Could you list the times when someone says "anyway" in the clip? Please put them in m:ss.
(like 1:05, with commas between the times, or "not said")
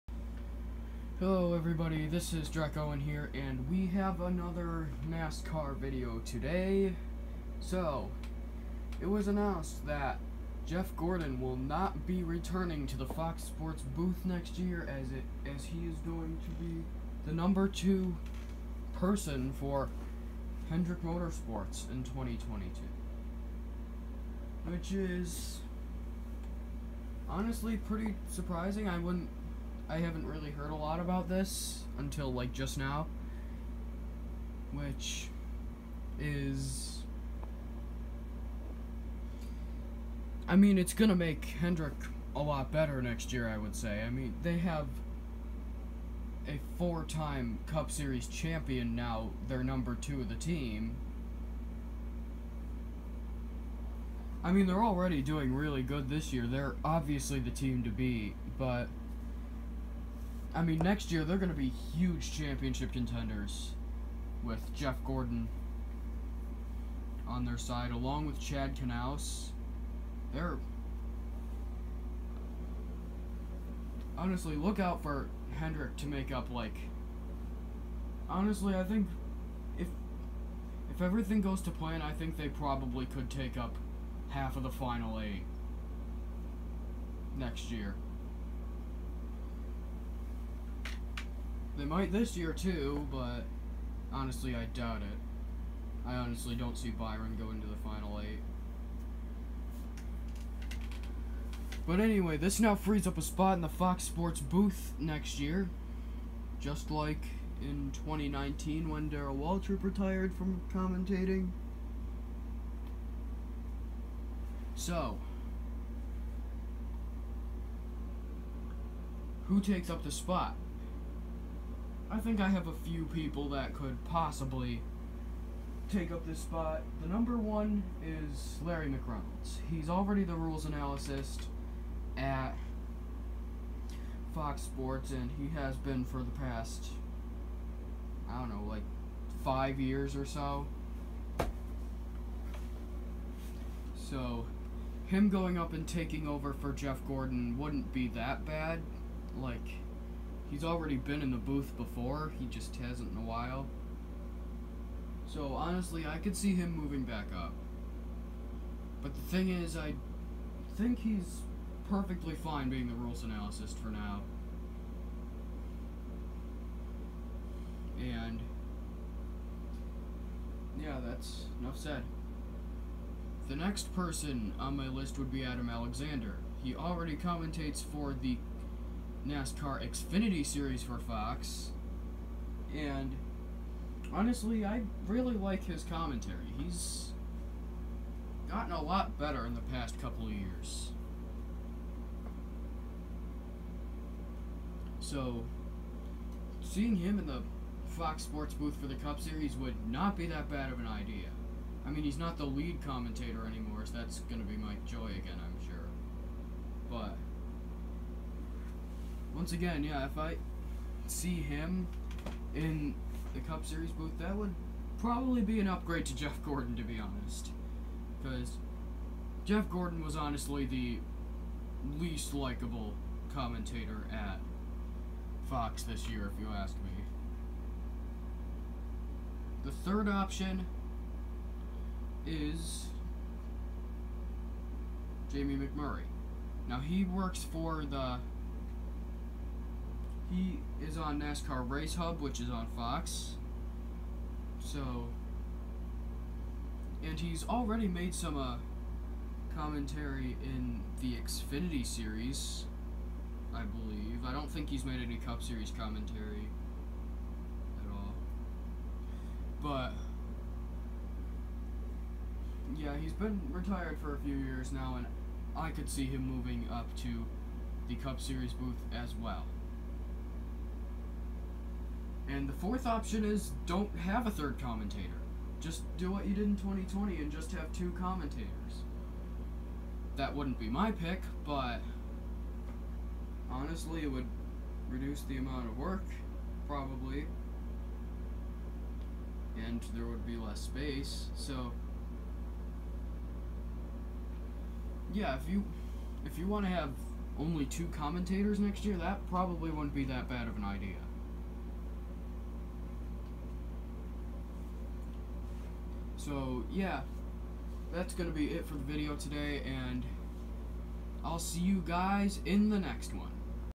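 1:41.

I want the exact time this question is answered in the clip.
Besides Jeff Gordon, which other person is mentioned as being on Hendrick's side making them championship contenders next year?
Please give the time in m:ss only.
1:08.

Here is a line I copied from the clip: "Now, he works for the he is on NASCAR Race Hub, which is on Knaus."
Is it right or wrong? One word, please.
wrong.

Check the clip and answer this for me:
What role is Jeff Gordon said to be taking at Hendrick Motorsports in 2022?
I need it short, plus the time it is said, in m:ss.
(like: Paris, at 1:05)
Number two person, at 0:17.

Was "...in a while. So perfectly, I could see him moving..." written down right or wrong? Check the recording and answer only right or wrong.
wrong.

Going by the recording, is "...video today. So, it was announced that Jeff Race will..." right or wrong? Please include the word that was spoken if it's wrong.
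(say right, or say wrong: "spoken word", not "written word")
wrong: "Gordon", not "Race".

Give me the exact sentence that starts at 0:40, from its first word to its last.
I mean, it's gonna make Hendrick a lot better next year, I would say.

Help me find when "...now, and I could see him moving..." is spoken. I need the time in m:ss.
4:24.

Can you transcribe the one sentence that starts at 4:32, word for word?
And the fourth option is don't have a third commentator.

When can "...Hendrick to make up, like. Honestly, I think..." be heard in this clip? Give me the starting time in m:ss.
1:15.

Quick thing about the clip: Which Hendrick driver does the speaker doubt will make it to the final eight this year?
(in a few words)
Byron.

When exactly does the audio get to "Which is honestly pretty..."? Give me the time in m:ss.
0:24.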